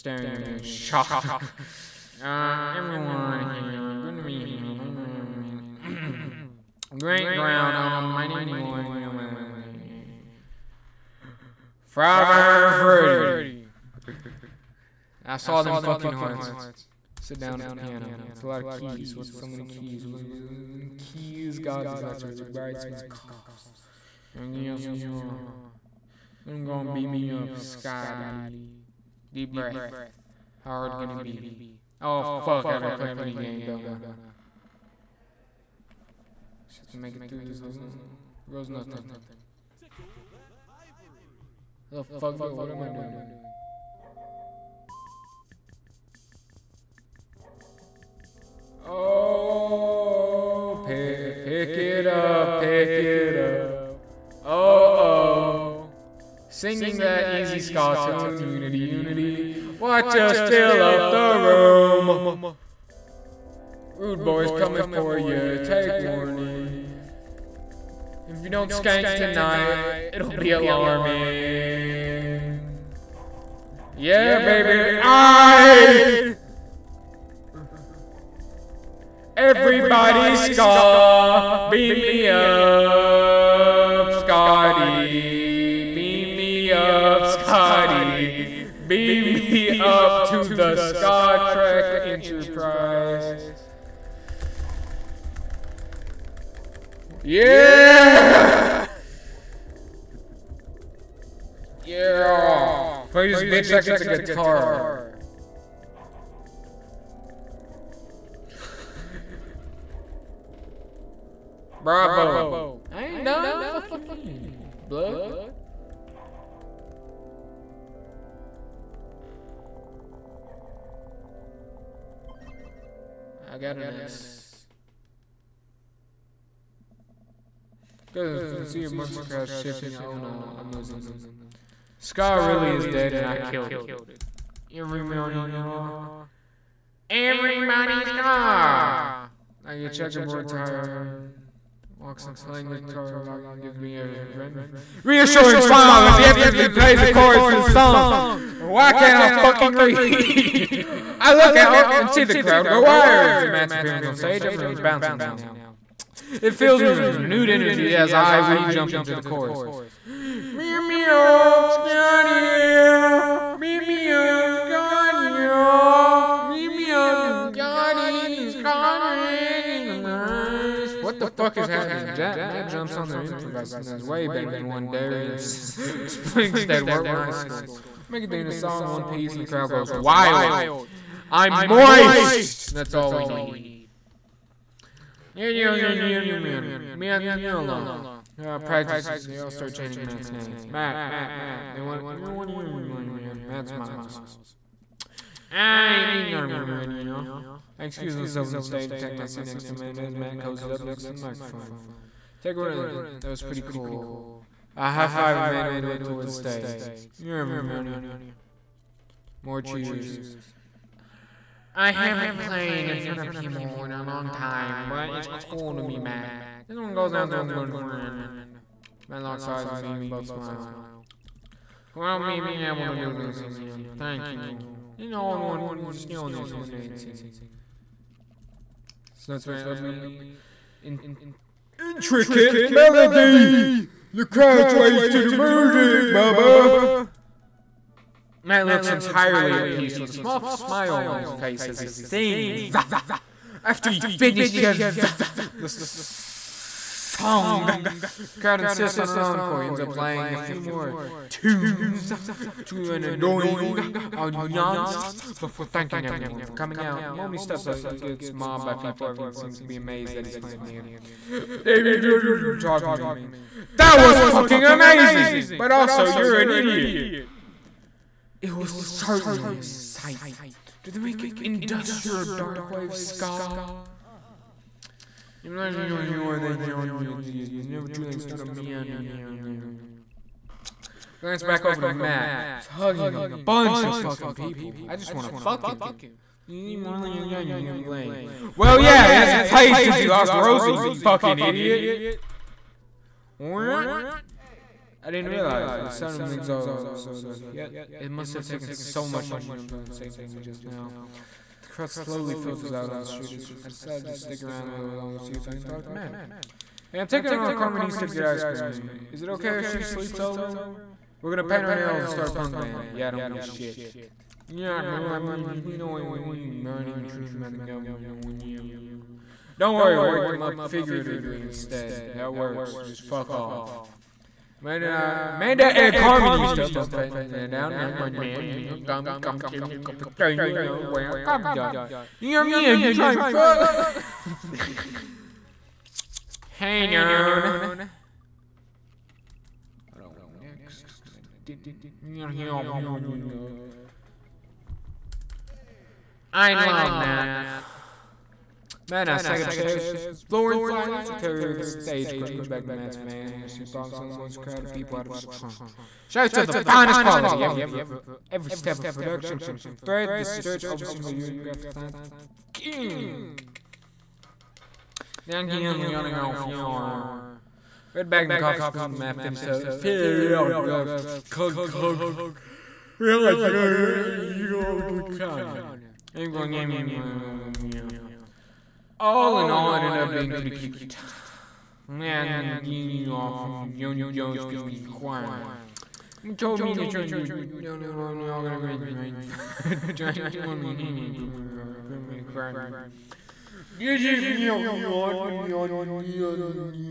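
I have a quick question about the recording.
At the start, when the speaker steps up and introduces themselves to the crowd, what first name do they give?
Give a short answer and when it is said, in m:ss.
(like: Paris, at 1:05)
Lauren, at 0:08.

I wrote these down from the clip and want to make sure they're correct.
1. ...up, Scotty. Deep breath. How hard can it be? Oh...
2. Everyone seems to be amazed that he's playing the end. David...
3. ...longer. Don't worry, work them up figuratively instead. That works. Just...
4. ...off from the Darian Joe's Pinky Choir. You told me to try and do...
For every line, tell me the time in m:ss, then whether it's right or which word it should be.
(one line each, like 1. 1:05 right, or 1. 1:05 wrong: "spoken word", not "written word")
1. 0:27 right
2. 4:19 right
3. 5:18 wrong: "whatever", not "longer"
4. 6:23 wrong: "Young", not "Darian".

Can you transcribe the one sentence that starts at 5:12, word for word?
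Yeah, I don't give a shit.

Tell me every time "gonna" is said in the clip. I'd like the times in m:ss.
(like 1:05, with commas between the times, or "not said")
0:26, 5:11, 6:28.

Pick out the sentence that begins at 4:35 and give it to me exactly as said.
You're not the only one that Johnny exists, We never truly started me on him here and there.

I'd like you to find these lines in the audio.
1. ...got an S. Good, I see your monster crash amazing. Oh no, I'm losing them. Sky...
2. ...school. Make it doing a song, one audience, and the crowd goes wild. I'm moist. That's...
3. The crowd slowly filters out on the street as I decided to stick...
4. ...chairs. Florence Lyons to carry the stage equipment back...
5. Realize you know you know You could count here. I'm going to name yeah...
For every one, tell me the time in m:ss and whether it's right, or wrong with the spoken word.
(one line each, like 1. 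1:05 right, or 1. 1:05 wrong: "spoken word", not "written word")
1. 2:03 wrong: "shifting", not "amazing"
2. 2:57 wrong: "piece", not "audience"
3. 5:01 right
4. 5:49 right
5. 6:09 right.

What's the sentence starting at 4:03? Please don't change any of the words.
After he finishes the song, the crowd insists on an encore.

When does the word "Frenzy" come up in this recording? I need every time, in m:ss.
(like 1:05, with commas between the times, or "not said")
0:12.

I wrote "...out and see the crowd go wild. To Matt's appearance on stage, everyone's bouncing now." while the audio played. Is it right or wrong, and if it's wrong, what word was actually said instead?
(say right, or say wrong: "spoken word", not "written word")
right.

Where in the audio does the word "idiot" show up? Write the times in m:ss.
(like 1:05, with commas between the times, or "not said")
4:26, 4:51.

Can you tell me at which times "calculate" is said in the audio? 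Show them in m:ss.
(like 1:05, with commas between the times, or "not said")
not said.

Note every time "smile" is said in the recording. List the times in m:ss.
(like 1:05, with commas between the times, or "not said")
2:25, 3:13, 3:40, 4:00.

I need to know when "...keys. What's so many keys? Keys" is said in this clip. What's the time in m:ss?
0:18.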